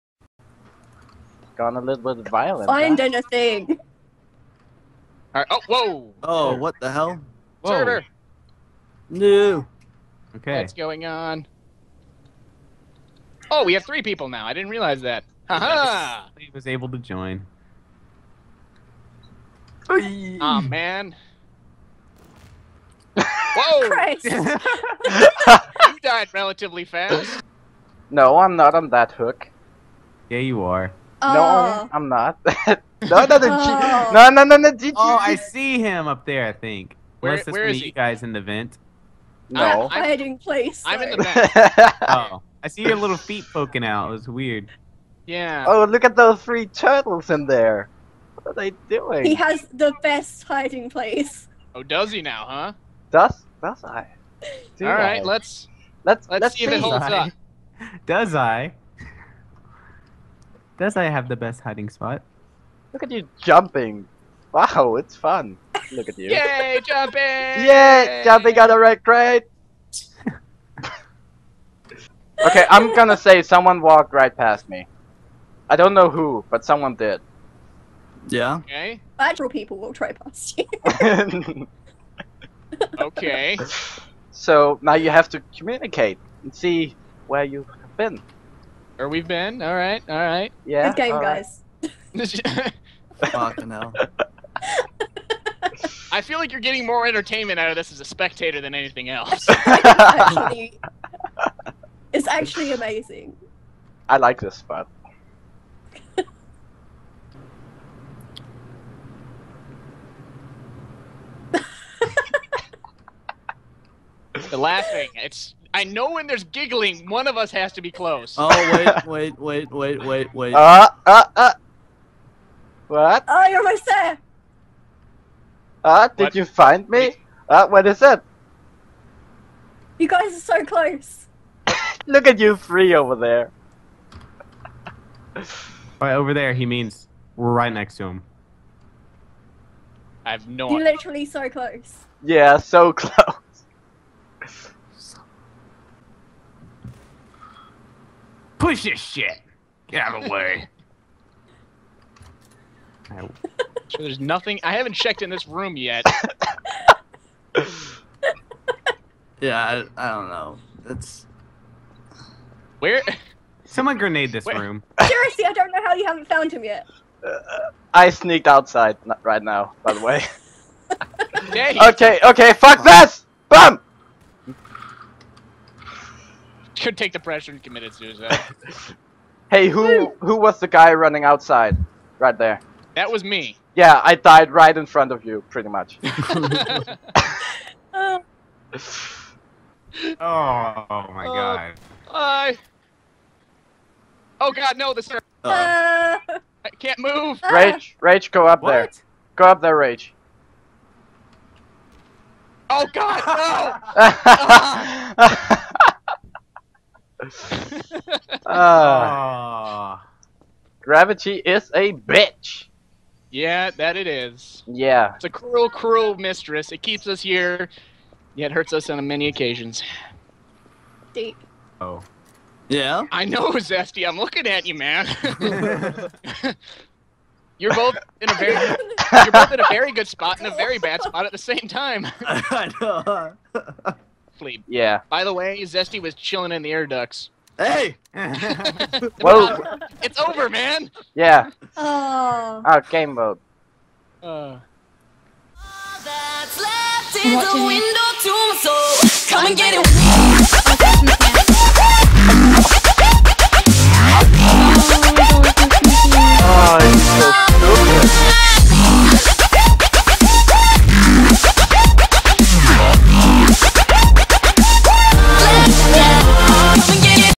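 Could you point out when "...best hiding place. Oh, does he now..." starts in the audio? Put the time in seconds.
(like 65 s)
50 s.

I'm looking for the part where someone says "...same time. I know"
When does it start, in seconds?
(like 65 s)
231 s.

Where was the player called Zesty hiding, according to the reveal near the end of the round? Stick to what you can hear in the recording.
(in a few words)
Air ducts.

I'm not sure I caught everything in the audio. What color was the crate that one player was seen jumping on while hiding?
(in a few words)
Red.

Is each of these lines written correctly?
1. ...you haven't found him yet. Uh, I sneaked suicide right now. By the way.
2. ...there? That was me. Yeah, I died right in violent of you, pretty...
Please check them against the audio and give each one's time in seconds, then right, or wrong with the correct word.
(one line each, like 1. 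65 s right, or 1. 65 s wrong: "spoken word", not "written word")
1. 165 s wrong: "outside", not "suicide"
2. 182 s wrong: "front", not "violent".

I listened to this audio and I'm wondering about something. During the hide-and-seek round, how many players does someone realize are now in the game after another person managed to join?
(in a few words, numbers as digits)
3.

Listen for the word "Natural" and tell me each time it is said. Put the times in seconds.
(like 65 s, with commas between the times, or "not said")
79 s.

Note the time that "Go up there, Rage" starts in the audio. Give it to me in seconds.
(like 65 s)
199 s.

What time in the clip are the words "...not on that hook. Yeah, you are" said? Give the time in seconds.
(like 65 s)
28 s.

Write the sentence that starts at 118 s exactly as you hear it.
Oh wait, wait, wait, wait, wait, wait.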